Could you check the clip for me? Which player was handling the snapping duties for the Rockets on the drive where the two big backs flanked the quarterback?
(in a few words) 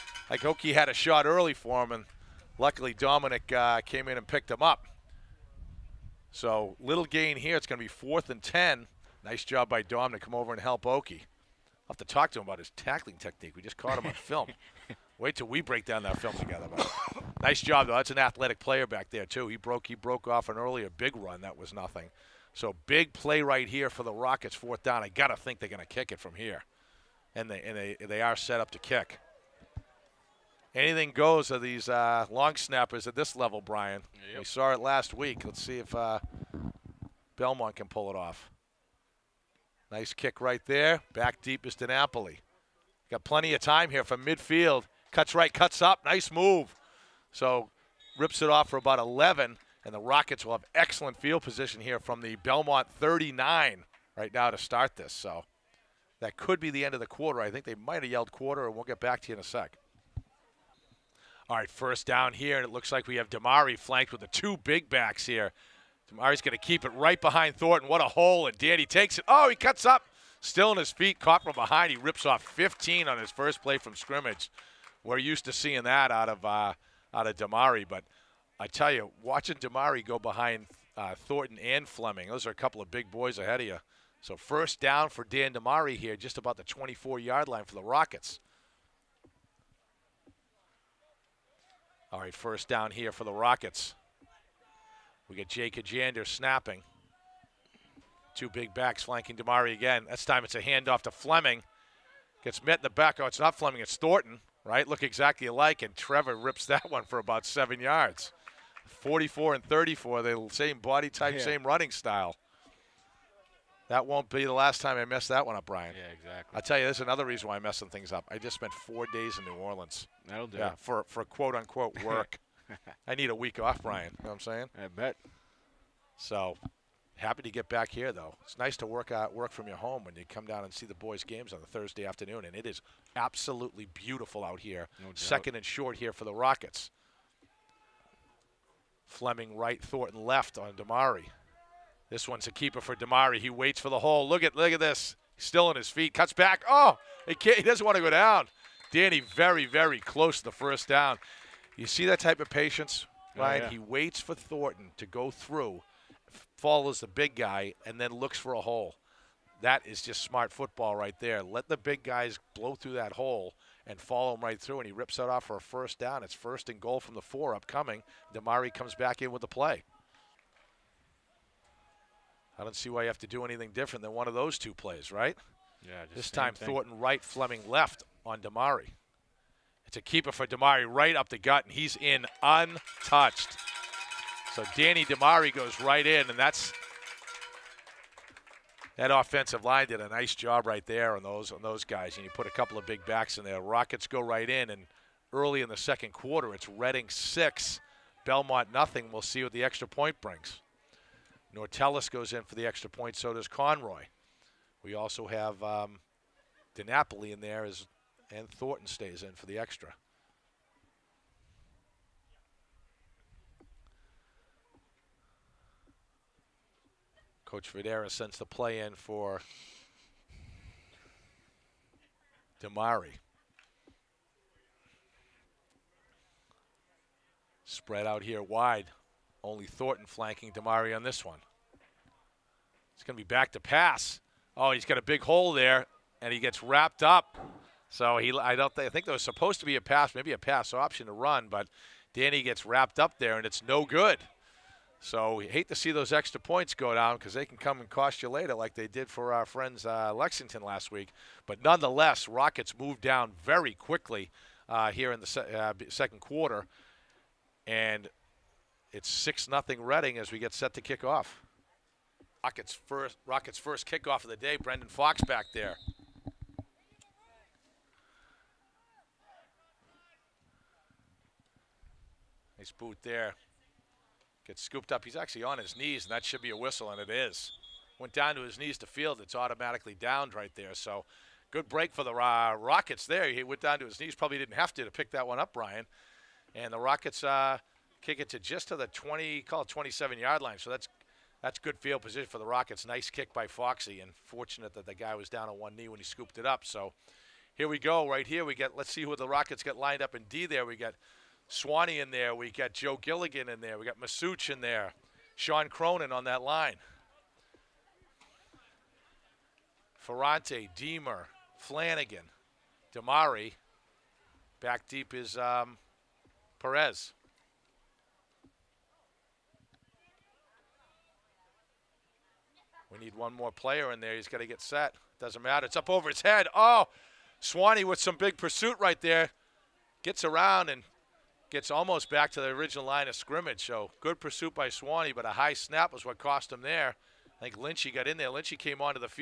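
Jake Kajander.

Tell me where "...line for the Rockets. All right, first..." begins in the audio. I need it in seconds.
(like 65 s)
87 s.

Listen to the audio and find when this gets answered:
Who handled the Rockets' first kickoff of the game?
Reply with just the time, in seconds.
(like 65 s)
264 s.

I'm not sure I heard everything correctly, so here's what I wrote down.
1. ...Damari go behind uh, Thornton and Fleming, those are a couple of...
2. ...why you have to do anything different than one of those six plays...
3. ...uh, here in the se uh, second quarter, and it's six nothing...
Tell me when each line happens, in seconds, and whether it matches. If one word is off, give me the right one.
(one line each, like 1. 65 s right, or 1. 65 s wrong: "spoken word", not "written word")
1. 79 s right
2. 172 s wrong: "two", not "six"
3. 254 s right.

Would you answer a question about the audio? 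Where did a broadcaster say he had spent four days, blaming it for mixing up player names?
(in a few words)
New Orleans.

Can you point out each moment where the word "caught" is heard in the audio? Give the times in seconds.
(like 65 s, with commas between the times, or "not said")
13 s, 71 s.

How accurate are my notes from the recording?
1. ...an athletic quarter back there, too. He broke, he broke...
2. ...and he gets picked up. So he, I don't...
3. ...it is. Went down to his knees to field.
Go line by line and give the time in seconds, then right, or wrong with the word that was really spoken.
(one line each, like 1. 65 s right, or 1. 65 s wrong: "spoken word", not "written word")
1. 18 s wrong: "player", not "quarter"
2. 236 s wrong: "wrapped", not "picked"
3. 276 s right.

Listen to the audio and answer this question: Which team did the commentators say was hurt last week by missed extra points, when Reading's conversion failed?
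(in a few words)
Lexington.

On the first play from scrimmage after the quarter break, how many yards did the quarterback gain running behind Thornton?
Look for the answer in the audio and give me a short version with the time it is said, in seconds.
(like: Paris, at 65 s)
15, at 72 s.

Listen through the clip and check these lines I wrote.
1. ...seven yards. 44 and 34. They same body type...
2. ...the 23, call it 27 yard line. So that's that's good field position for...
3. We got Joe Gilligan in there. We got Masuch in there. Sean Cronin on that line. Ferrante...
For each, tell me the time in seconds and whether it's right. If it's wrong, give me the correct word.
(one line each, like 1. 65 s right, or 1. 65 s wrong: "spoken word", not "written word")
1. 107 s right
2. 288 s wrong: "20", not "23"
3. 302 s right.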